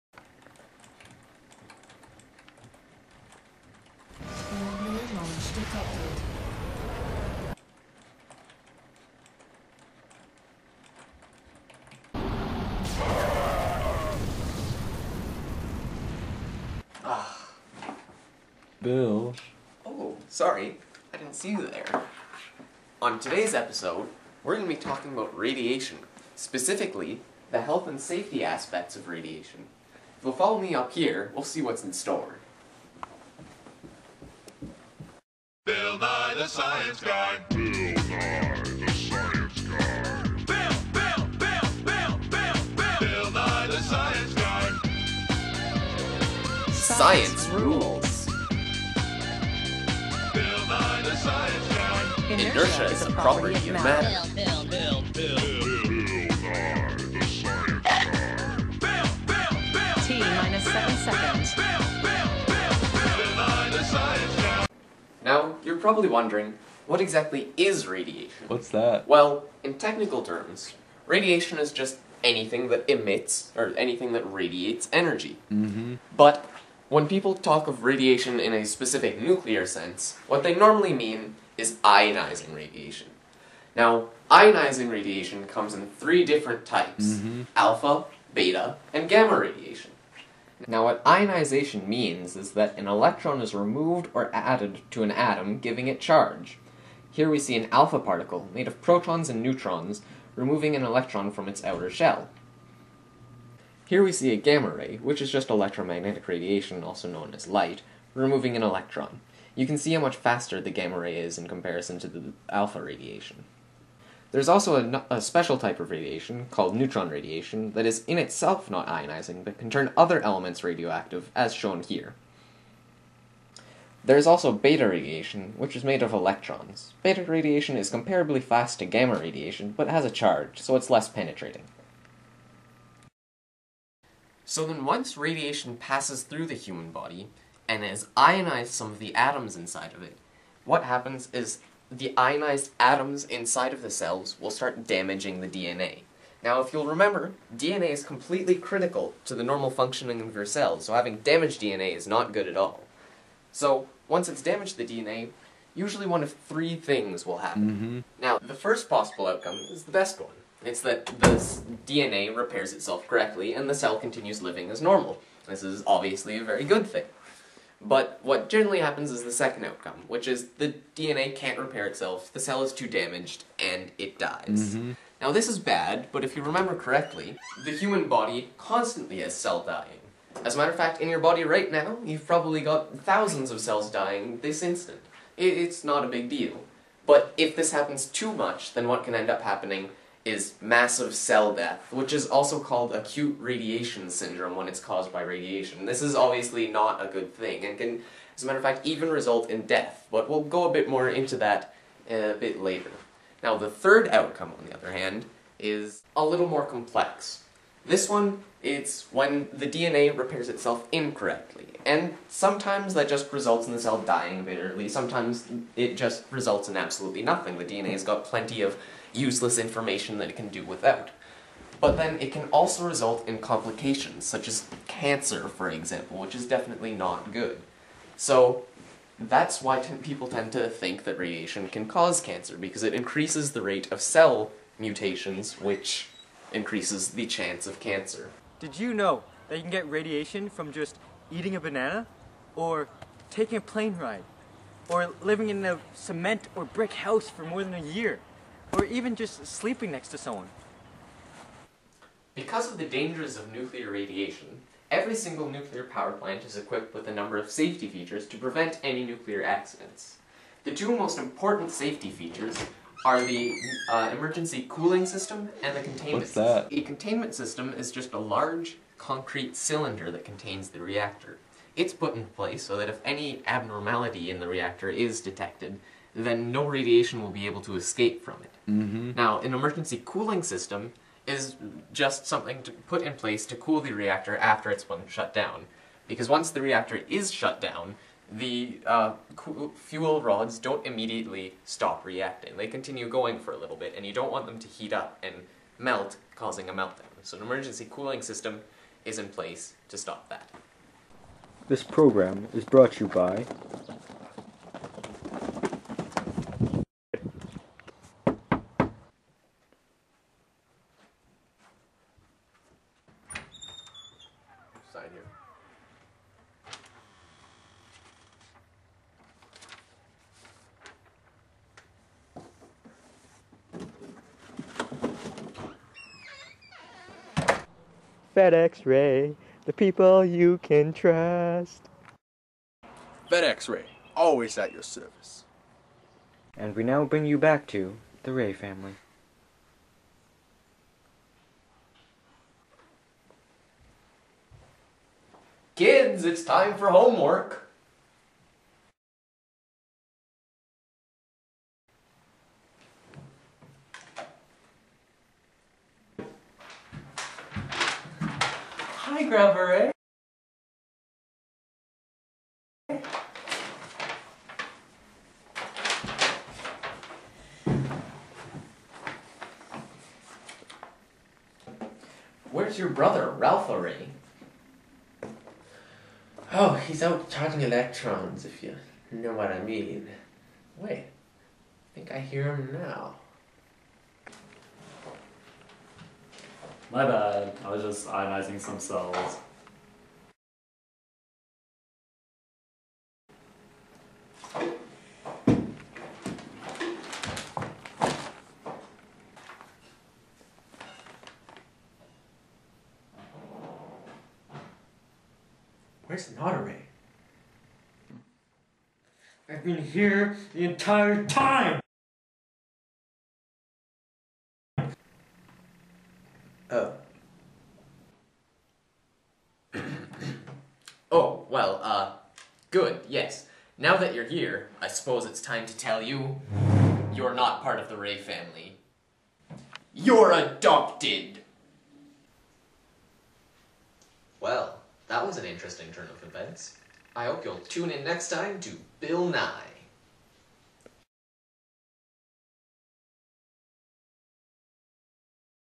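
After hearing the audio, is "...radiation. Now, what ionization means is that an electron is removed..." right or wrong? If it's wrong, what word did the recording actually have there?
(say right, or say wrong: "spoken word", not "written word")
right.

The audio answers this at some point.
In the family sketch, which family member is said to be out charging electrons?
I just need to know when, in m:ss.
6:13.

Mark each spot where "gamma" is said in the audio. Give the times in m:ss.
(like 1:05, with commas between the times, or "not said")
1:29, 1:44, 1:50, 2:08.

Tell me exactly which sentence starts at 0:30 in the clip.
If you'll follow me up here, we'll see what's in store.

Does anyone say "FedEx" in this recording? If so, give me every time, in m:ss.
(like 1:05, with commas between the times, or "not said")
5:28, 5:33.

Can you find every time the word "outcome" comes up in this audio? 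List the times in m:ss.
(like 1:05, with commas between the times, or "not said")
2:39, 2:49, 3:24.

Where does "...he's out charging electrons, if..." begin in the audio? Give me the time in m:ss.
6:16.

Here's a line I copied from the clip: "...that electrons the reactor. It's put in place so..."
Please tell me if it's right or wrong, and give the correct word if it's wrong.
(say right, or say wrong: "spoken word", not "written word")
wrong: "contains", not "electrons".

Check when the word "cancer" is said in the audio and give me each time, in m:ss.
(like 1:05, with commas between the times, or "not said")
3:44, 3:52, 3:57.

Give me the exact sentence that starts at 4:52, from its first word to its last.
They continue going for a little bit, and you don't want them to heat up and melt, causing a meltdown.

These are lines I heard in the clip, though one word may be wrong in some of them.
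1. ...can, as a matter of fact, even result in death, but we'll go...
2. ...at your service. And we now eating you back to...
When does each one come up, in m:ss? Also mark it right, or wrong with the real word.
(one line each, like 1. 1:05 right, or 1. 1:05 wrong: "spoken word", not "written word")
1. 3:17 right
2. 5:34 wrong: "bring", not "eating".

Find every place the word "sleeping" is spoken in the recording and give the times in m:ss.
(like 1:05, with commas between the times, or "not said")
4:09.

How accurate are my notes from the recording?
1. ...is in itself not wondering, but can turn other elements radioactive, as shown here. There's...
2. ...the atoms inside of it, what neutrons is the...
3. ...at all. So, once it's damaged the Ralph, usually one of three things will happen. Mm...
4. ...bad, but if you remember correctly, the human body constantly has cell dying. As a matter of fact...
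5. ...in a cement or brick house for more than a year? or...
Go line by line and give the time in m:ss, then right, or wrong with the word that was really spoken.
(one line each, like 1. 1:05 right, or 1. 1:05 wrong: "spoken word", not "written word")
1. 1:57 wrong: "ionizing", not "wondering"
2. 2:18 wrong: "happens", not "neutrons"
3. 2:32 wrong: "DNA", not "Ralph"
4. 2:55 right
5. 4:05 right.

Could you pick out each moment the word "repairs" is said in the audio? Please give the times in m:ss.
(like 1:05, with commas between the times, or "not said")
2:42, 2:51, 3:30.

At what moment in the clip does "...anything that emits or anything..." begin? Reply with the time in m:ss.
1:12.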